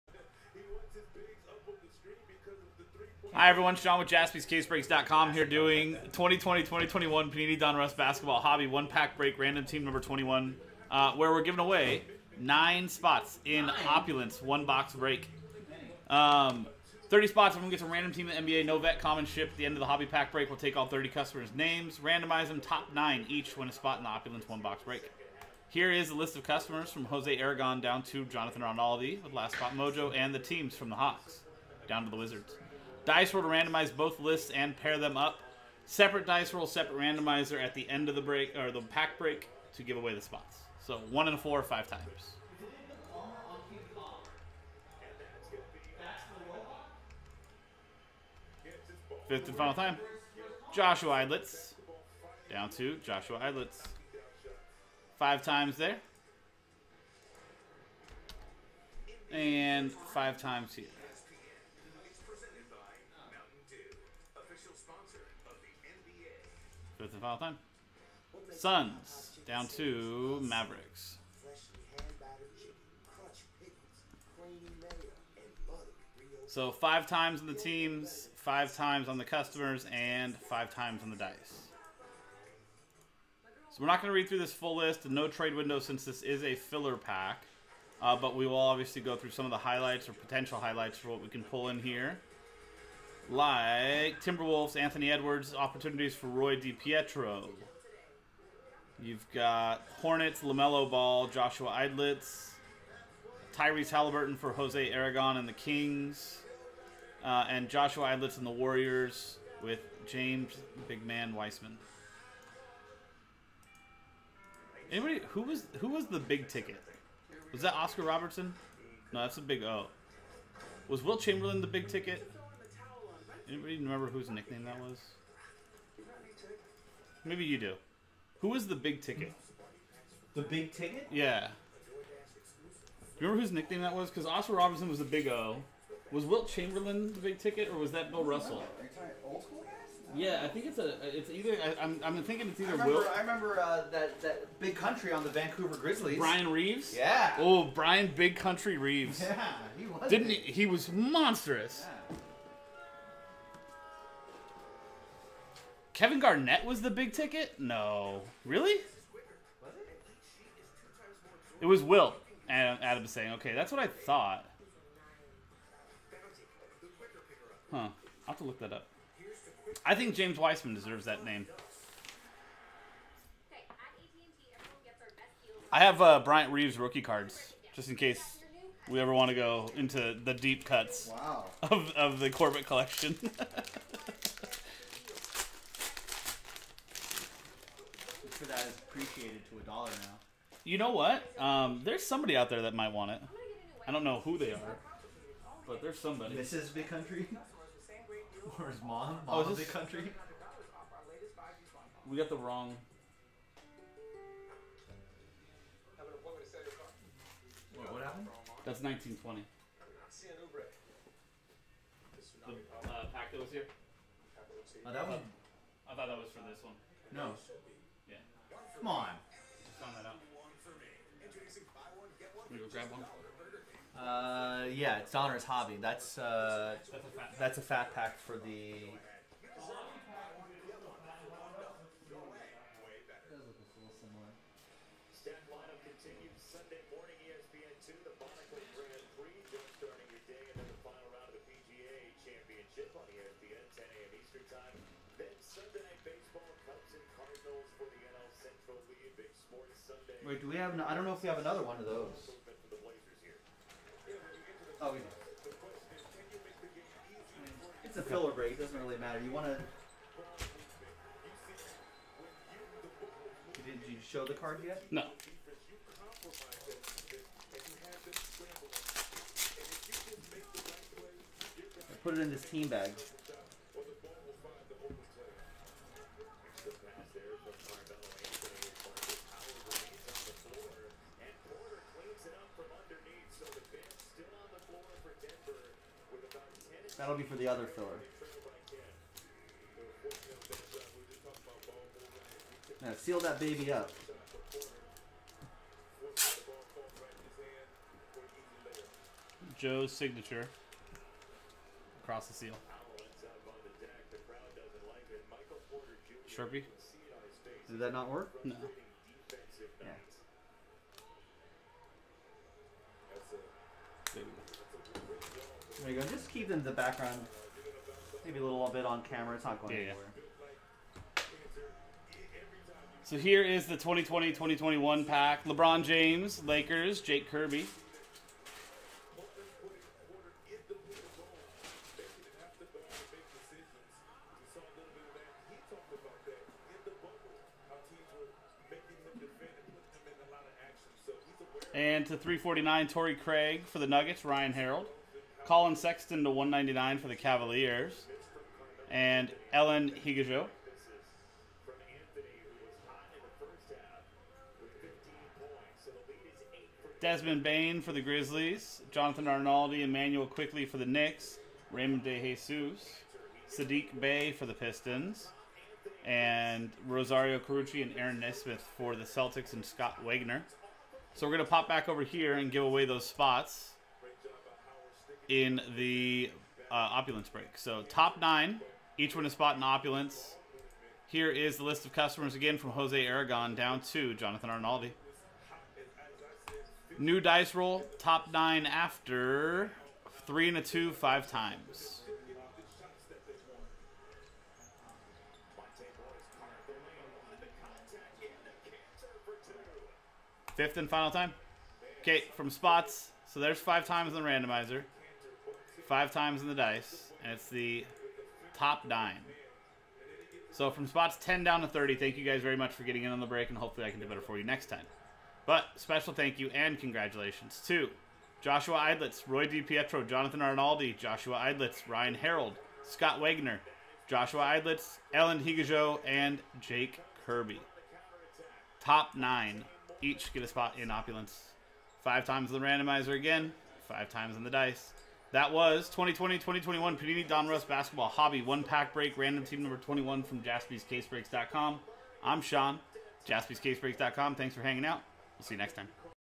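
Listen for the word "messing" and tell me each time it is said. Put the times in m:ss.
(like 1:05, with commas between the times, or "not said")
not said.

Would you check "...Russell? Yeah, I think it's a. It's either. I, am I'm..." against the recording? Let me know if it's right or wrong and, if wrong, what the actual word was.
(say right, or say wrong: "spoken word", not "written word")
right.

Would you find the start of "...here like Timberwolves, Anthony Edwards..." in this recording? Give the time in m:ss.
1:31.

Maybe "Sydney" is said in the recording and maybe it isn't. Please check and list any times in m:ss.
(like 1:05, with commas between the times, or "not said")
not said.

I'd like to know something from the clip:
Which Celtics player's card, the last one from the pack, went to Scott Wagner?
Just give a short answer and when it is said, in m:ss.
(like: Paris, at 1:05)
Aaron Nesmith, at 6:07.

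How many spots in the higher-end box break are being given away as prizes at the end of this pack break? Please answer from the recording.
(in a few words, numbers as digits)
9.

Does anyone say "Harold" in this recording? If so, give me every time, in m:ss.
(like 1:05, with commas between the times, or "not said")
5:44, 7:02.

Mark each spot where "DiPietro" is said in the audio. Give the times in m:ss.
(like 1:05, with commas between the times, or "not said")
1:36, 6:59.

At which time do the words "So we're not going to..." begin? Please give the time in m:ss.
1:23.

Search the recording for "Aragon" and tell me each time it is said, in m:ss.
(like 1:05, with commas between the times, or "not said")
0:27, 1:44, 6:23.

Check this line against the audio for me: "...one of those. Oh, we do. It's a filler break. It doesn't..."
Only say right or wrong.
right.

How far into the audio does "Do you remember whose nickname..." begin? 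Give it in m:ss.
2:11.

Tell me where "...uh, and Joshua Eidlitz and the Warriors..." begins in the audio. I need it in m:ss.
1:47.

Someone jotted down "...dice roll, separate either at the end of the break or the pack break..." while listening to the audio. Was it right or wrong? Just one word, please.
wrong.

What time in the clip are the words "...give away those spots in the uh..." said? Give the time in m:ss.
6:12.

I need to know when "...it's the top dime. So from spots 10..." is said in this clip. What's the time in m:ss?
6:47.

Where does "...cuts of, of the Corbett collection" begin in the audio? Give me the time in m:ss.
3:00.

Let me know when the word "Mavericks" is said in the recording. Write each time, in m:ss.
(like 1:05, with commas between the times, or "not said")
1:10.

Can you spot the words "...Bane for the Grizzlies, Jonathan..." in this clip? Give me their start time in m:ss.
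5:57.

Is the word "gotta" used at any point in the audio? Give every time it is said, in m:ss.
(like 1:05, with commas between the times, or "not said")
not said.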